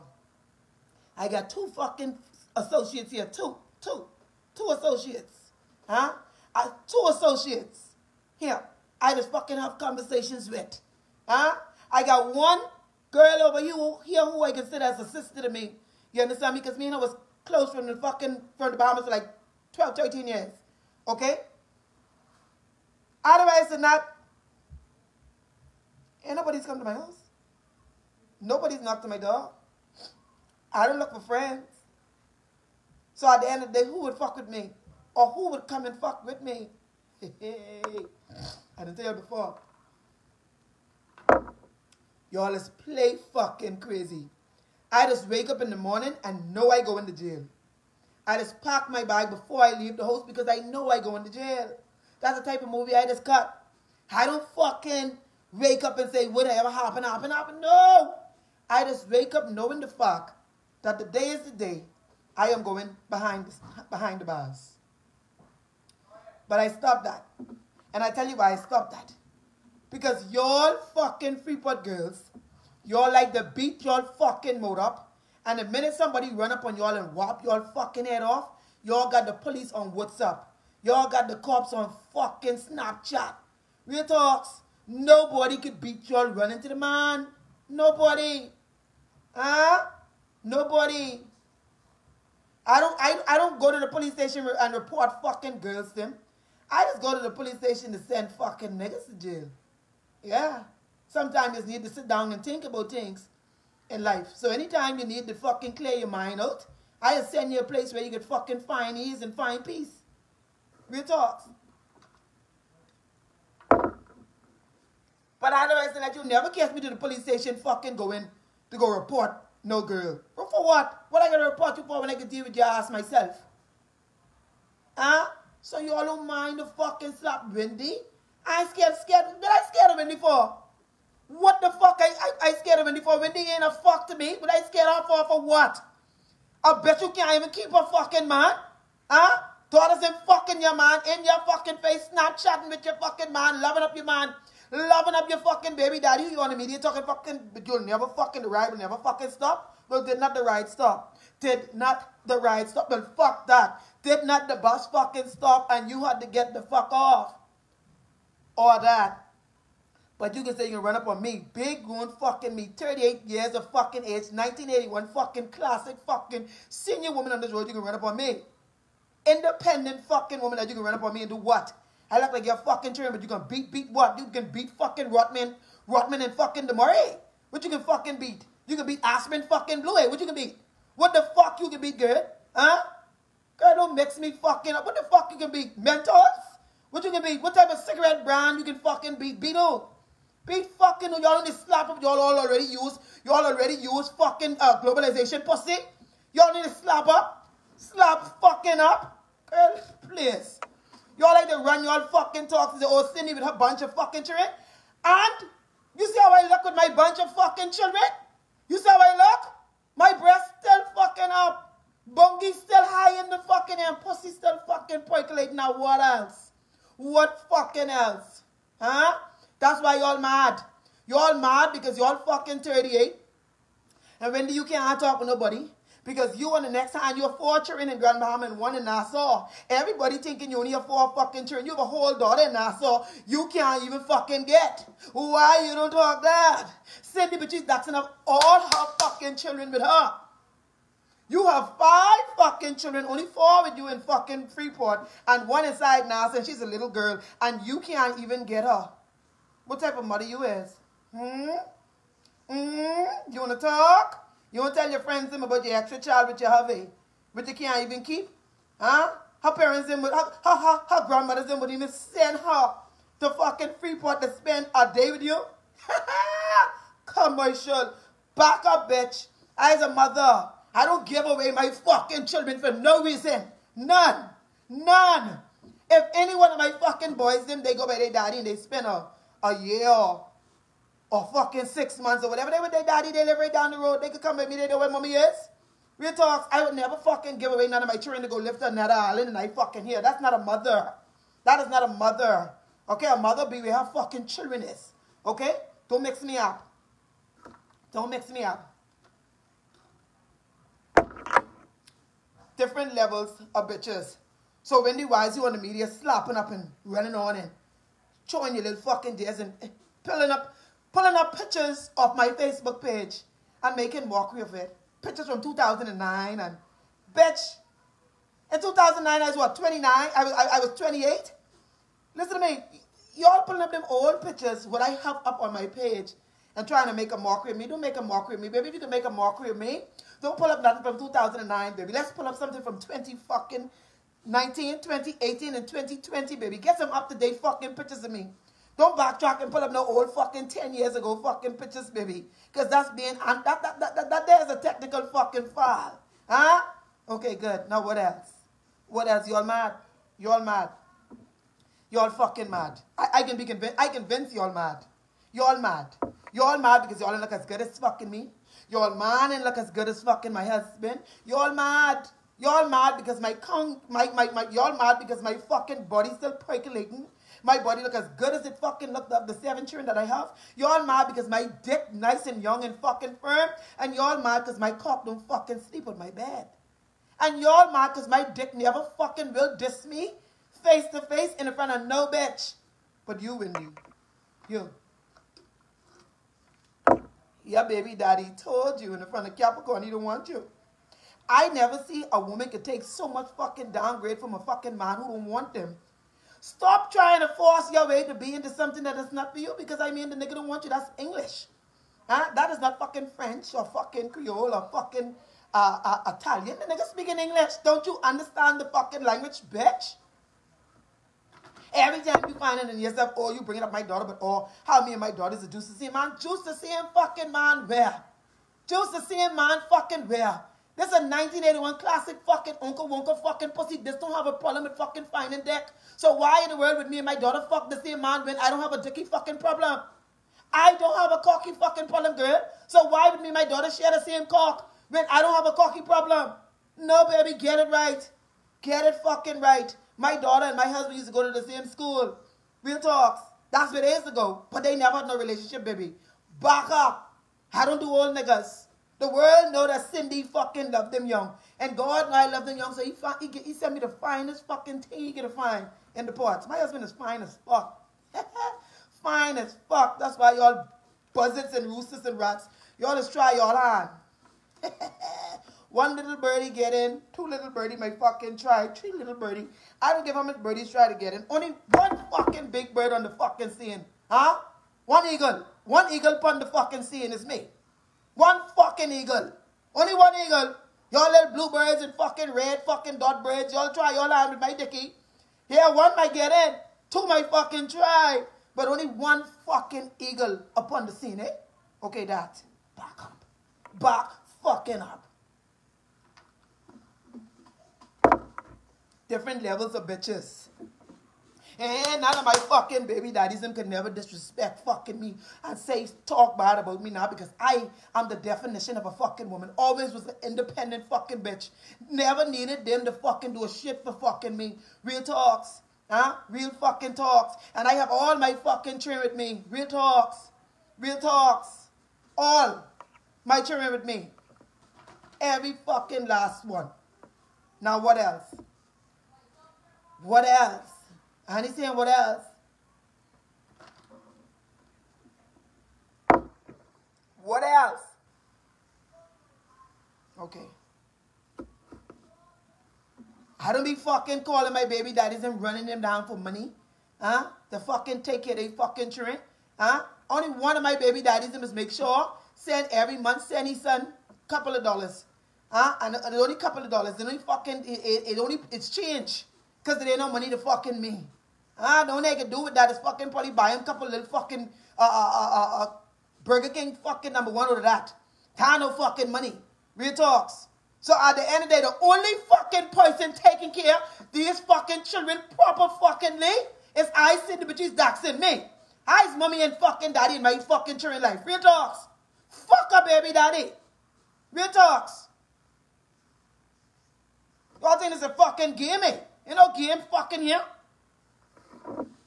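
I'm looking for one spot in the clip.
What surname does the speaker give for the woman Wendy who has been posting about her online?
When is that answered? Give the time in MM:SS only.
05:05.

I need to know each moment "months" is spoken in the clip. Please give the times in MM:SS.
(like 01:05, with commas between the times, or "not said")
04:41, 09:12.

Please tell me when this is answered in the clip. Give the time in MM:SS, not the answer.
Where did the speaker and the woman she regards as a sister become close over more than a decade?
00:18.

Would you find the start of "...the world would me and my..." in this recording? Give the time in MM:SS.
07:06.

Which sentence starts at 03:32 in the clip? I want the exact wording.
Bungie still high in the fucking air.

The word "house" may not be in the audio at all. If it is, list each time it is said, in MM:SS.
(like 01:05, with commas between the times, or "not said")
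00:26, 00:50.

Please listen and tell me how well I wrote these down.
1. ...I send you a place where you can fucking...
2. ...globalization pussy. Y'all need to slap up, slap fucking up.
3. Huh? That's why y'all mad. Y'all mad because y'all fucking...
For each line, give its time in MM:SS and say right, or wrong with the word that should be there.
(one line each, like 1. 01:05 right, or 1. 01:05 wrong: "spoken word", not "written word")
1. 01:46 right
2. 03:14 right
3. 03:38 right.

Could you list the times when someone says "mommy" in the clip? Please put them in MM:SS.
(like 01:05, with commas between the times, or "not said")
04:44, 09:39.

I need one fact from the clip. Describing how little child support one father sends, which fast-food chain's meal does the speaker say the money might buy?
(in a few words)
Burger King.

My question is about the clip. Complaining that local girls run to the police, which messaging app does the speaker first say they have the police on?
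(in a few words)
WhatsApp.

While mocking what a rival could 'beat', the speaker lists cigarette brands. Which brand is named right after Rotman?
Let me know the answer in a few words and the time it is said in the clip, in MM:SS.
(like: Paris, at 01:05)
Du Maurier, at 02:56.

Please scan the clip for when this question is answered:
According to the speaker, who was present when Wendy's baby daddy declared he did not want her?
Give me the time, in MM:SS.
06:29.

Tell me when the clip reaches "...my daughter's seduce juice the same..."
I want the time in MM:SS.
06:54.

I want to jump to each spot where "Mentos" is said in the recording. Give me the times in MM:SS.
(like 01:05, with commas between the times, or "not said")
03:05.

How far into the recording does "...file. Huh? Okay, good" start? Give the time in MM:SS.
05:45.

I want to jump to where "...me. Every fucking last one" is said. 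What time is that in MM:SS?
08:43.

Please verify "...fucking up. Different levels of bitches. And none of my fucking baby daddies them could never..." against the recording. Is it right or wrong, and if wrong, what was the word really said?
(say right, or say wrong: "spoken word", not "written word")
right.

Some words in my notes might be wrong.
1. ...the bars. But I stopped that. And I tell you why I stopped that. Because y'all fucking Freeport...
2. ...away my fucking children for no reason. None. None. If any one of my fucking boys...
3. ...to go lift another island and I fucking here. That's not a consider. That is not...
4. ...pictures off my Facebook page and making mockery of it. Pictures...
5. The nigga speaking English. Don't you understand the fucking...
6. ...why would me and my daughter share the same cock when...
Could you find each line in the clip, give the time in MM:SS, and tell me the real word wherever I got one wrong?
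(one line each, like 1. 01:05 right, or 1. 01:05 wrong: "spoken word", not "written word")
1. 01:04 right
2. 04:31 right
3. 04:48 wrong: "mother", not "consider"
4. 05:11 right
5. 06:46 right
6. 07:12 right.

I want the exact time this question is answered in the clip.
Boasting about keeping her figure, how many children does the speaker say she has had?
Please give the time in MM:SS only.
06:09.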